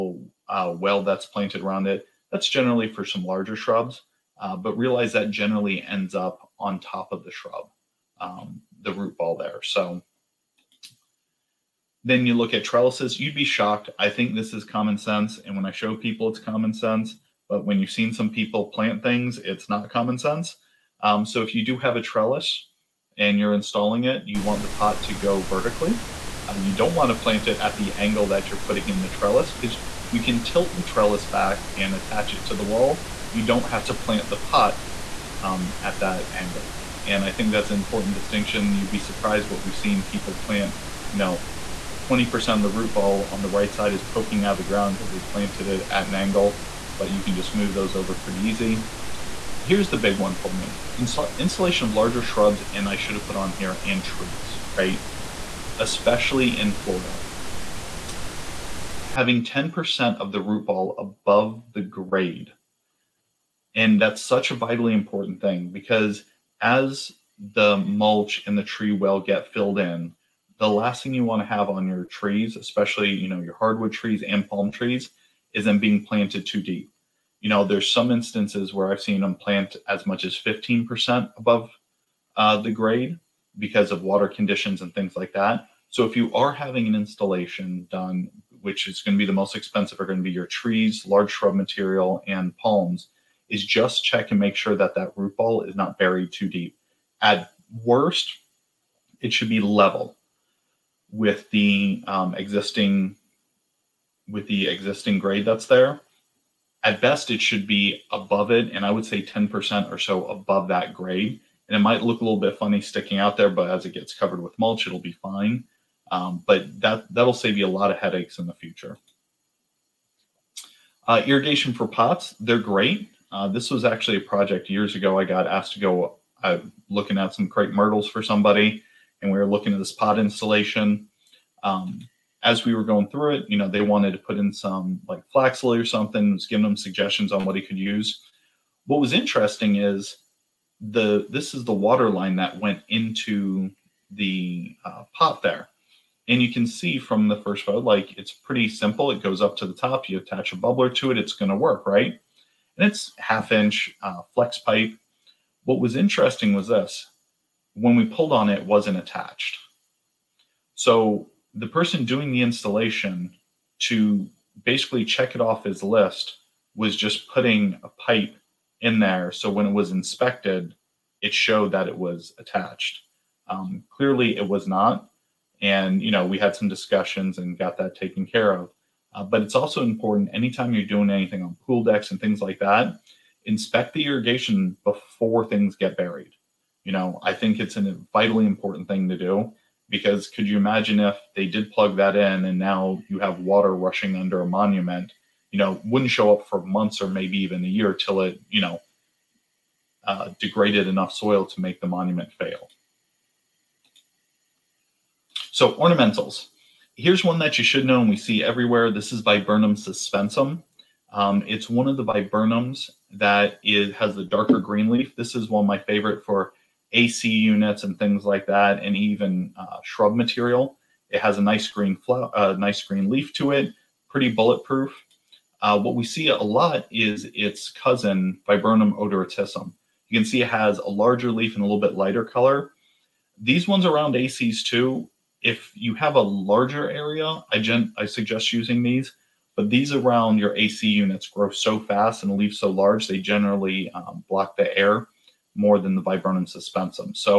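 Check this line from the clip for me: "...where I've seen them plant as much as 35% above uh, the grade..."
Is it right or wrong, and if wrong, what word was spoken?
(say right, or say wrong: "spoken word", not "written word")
wrong: "15", not "35".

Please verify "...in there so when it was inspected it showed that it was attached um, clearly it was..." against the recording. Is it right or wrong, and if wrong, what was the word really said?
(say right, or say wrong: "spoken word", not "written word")
right.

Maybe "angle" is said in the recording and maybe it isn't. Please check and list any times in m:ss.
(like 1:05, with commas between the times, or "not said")
0:27, 0:36, 0:46.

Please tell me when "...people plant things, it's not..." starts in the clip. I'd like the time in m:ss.
0:18.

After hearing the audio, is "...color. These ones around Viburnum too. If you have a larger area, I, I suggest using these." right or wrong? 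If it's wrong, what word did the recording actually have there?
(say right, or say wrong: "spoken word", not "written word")
wrong: "ACs", not "Viburnum".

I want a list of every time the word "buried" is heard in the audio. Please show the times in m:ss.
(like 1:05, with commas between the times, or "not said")
1:35, 3:05.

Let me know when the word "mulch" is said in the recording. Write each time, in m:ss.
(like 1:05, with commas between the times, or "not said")
1:07, 1:54.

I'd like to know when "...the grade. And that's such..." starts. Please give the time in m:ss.
1:01.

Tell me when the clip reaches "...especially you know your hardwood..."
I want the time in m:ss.
1:12.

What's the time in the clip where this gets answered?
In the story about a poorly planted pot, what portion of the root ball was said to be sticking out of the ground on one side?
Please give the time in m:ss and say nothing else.
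0:42.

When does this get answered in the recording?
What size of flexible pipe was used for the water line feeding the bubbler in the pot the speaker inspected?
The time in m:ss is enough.
2:33.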